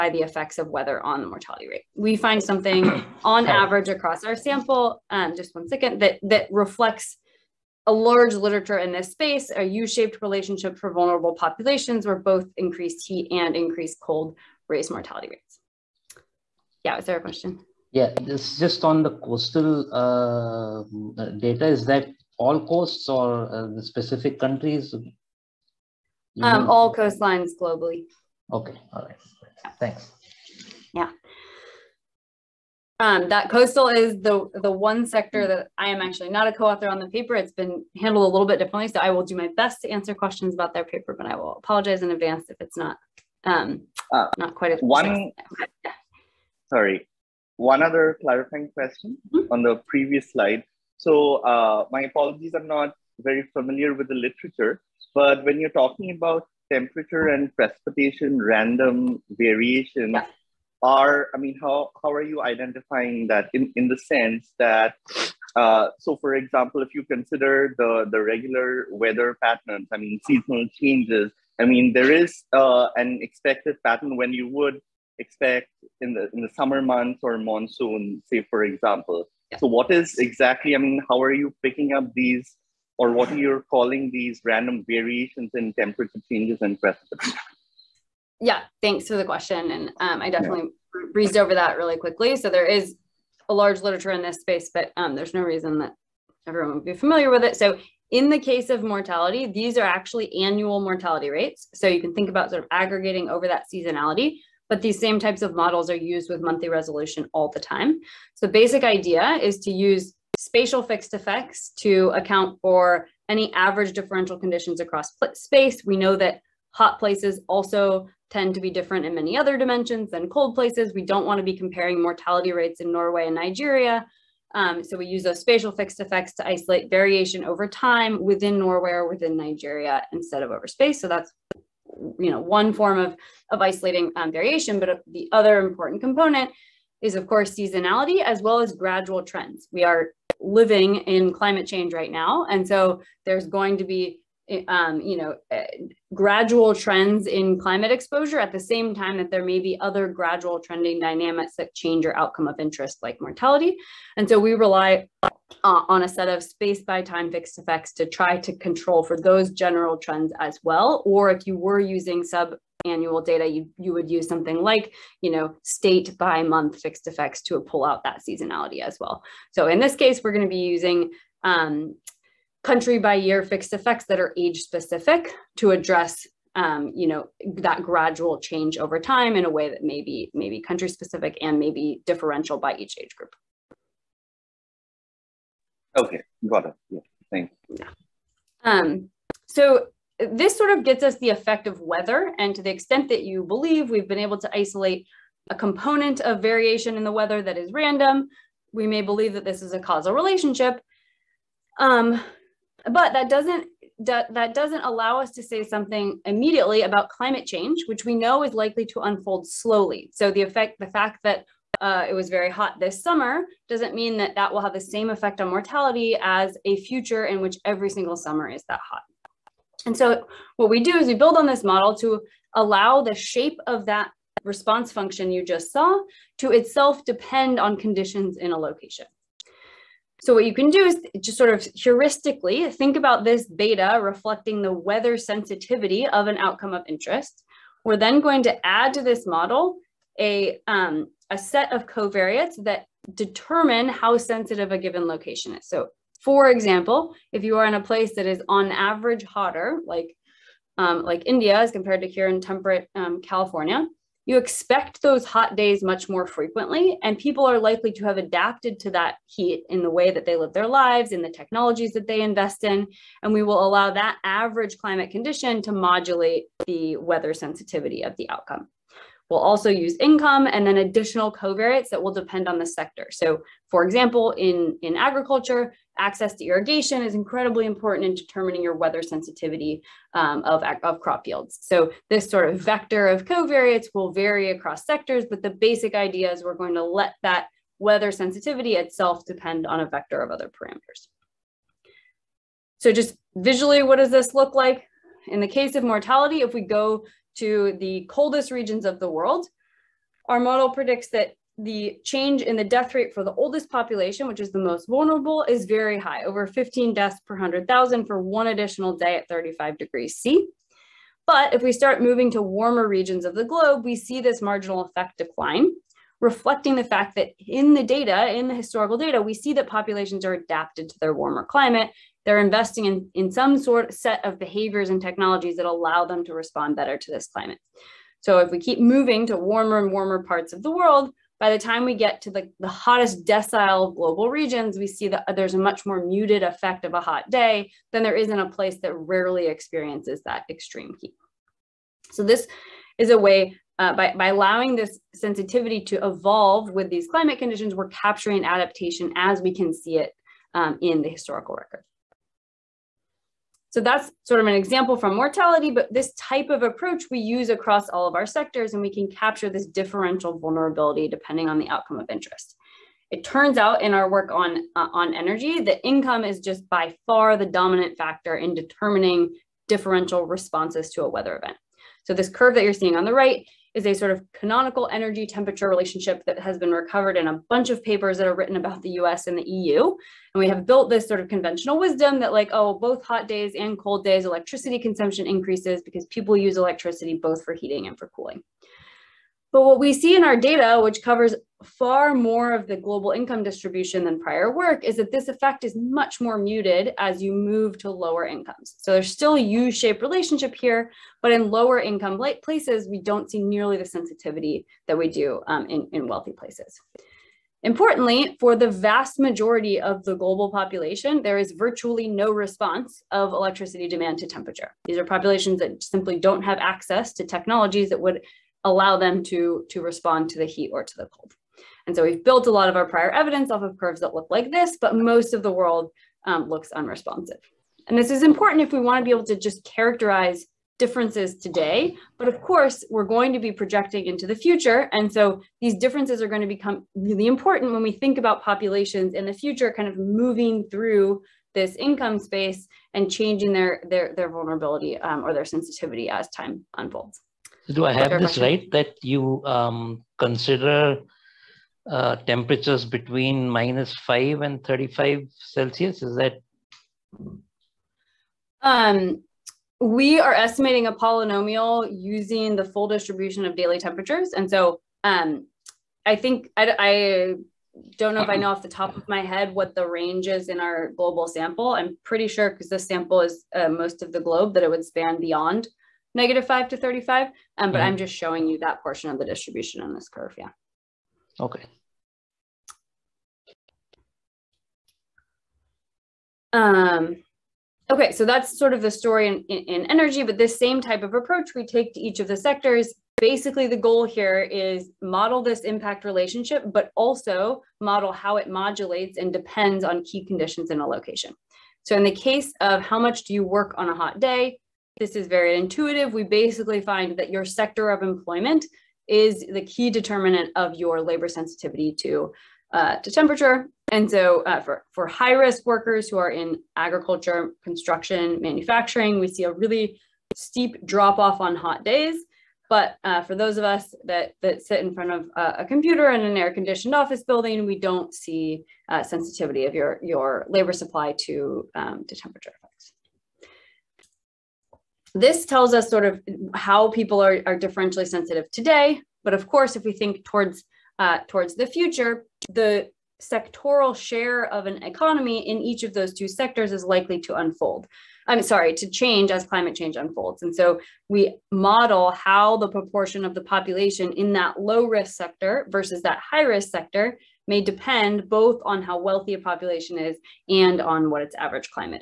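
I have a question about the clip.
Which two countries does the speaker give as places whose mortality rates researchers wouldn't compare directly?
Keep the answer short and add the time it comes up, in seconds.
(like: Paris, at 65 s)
Norway and Nigeria, at 122 s.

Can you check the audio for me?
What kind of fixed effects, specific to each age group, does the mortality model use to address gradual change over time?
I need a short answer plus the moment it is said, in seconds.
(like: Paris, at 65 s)
country by year, at 172 s.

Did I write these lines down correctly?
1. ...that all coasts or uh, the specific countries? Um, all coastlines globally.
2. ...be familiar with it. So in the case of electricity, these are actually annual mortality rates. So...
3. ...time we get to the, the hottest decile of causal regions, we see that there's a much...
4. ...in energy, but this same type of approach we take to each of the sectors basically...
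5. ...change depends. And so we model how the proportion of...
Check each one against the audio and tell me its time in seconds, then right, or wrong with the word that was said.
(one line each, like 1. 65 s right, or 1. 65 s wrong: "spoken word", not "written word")
1. 21 s right
2. 96 s wrong: "mortality", not "electricity"
3. 331 s wrong: "global", not "causal"
4. 489 s right
5. 549 s wrong: "unfolds", not "depends".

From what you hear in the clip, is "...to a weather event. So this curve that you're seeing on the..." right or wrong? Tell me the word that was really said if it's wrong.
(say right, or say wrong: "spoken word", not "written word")
right.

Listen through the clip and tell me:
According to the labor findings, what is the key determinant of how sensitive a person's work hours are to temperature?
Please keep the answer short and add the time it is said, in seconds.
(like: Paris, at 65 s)
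sector of employment, at 507 s.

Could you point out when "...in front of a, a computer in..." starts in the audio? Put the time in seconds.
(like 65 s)
524 s.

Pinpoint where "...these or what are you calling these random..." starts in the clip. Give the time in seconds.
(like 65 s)
82 s.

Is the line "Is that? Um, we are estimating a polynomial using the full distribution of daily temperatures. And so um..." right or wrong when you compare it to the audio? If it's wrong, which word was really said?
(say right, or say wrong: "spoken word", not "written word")
right.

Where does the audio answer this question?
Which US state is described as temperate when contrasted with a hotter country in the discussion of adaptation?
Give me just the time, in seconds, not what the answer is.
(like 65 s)
253 s.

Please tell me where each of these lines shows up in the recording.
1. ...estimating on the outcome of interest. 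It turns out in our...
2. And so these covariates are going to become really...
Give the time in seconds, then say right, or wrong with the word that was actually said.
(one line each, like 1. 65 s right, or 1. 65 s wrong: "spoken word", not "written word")
1. 361 s wrong: "depending", not "estimating"
2. 434 s wrong: "differences", not "covariates".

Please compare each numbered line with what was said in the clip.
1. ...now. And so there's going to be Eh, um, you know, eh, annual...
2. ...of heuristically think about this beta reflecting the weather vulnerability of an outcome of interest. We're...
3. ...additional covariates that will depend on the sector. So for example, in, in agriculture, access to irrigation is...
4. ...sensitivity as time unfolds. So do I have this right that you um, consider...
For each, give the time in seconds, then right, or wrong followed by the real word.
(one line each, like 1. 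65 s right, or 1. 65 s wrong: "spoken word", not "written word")
1. 142 s wrong: "gradual", not "annual"
2. 231 s wrong: "sensitivity", not "vulnerability"
3. 270 s right
4. 445 s right.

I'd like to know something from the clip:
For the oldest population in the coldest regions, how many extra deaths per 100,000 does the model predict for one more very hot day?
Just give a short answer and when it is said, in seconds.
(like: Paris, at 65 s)
over 15, at 306 s.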